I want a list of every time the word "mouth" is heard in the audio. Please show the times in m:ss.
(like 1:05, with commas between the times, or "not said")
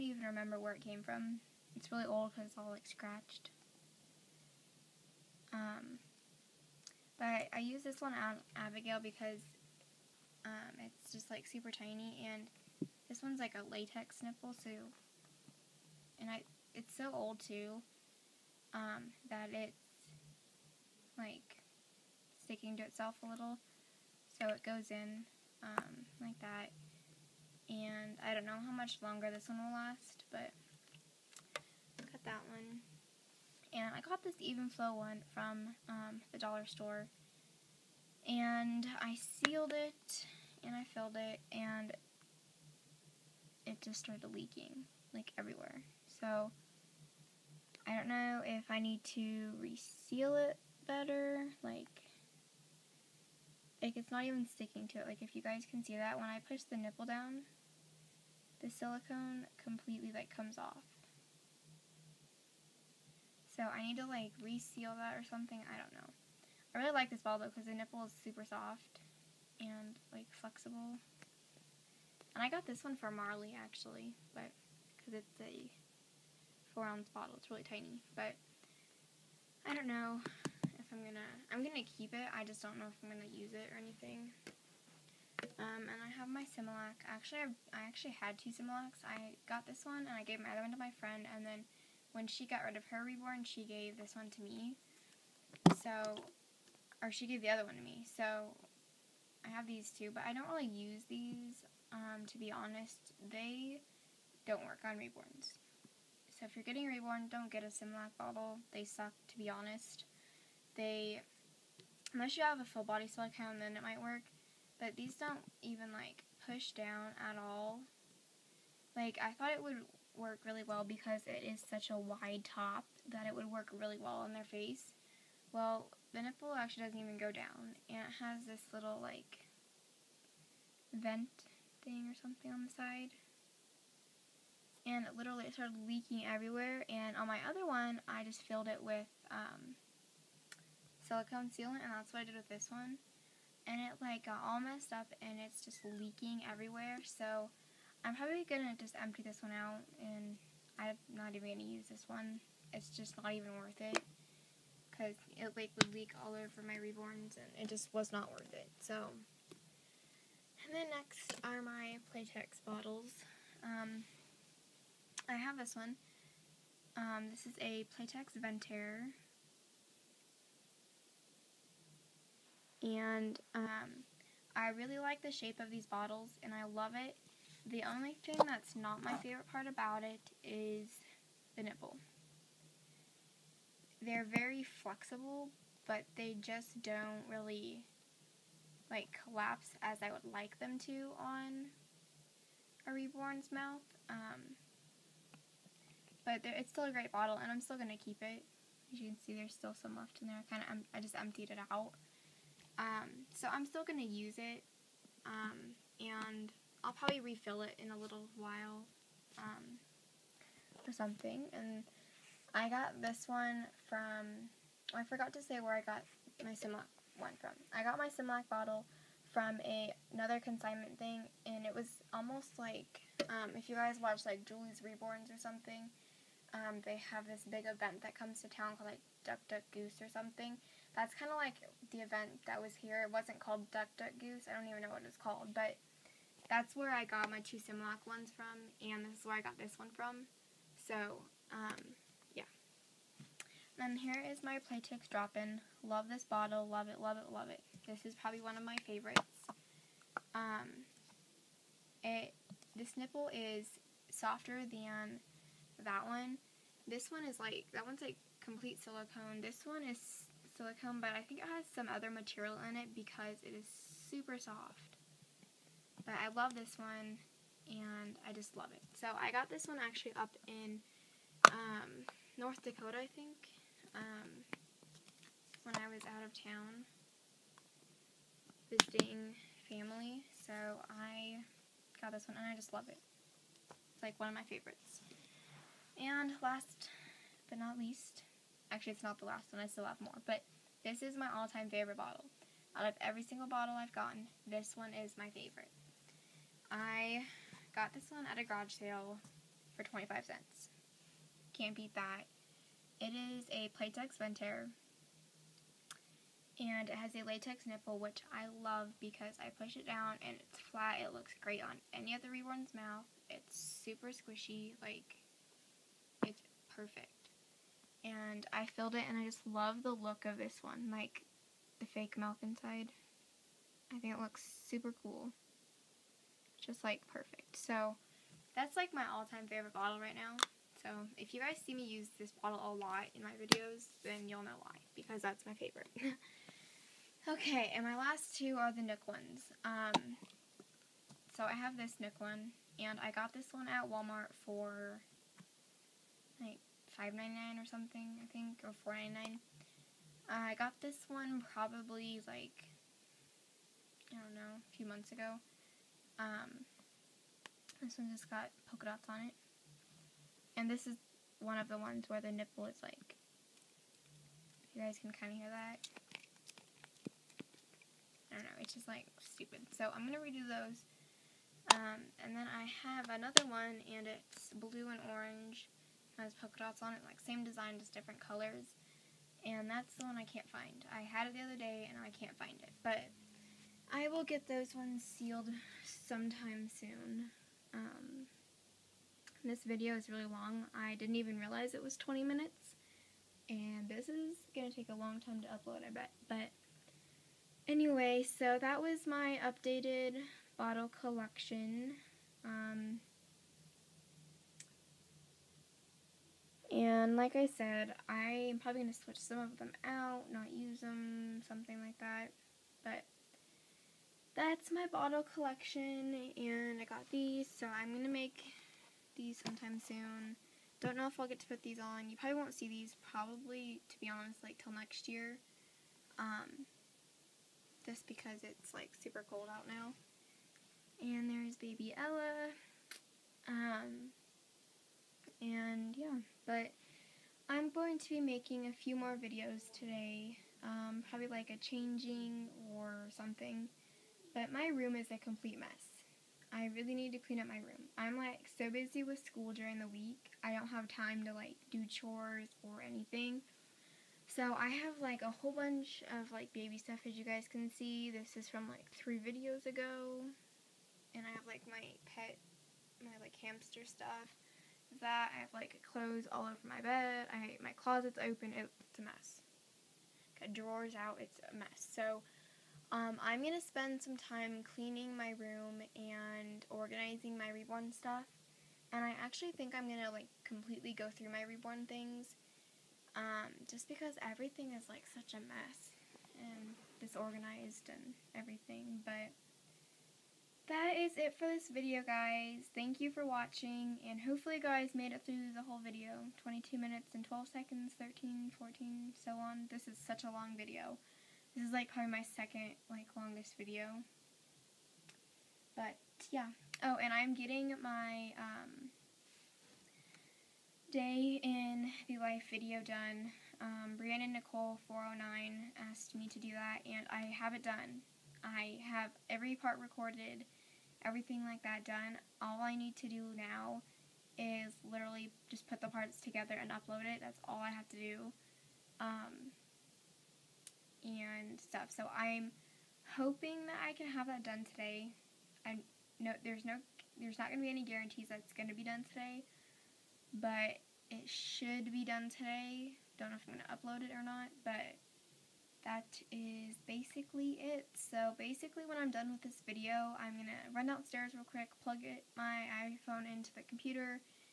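3:13, 5:12.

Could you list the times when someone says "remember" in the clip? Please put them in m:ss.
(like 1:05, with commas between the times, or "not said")
0:00.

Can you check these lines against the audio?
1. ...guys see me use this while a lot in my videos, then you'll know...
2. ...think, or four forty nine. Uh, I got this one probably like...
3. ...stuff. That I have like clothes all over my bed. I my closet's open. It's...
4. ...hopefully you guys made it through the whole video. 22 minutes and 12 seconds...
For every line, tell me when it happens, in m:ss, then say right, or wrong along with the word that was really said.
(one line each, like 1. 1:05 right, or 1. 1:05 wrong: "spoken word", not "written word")
1. 5:31 wrong: "bottle", not "while"
2. 5:48 wrong: "ninety", not "forty"
3. 7:43 right
4. 8:14 right.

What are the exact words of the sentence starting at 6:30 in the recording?
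I didn't even realize it was 20 minutes.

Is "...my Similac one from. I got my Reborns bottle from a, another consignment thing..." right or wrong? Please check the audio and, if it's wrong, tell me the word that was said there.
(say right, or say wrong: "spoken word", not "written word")
wrong: "Similac", not "Reborns".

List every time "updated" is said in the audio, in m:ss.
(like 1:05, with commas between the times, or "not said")
6:39.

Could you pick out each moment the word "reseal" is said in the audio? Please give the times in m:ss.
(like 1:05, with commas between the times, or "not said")
0:49, 1:04.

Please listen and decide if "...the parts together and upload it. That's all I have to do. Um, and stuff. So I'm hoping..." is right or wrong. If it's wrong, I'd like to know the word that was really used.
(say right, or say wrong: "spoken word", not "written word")
right.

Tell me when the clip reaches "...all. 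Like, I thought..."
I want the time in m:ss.
1:57.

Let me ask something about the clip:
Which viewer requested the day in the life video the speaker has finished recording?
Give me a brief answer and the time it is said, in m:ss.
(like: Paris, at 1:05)
Brianna Nicole 409, at 8:33.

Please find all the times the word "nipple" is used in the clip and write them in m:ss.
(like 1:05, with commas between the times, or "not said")
0:14, 0:56, 1:07, 2:06, 3:01, 4:12, 5:07, 6:02.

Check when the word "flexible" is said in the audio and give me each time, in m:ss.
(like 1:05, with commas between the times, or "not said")
1:10, 3:04.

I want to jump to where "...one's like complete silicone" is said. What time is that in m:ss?
4:17.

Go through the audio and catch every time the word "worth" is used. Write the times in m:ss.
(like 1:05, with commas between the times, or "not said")
2:33, 2:38.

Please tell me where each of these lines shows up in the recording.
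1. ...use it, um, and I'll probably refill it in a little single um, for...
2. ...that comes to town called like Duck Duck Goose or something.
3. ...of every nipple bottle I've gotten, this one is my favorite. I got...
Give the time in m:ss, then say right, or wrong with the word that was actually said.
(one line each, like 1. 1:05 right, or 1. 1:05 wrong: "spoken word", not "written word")
1. 3:24 wrong: "while", not "single"
2. 3:48 right
3. 4:52 wrong: "single", not "nipple".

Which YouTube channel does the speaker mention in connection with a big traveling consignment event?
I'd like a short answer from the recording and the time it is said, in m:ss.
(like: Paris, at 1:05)
Julie's Reborns, at 3:44.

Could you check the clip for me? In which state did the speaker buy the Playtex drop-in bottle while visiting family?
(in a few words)
North Dakota.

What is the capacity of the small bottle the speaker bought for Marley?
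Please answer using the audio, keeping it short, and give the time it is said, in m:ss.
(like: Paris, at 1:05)
4 ounces, at 1:16.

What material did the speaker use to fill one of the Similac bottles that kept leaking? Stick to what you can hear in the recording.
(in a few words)
silicone sealant.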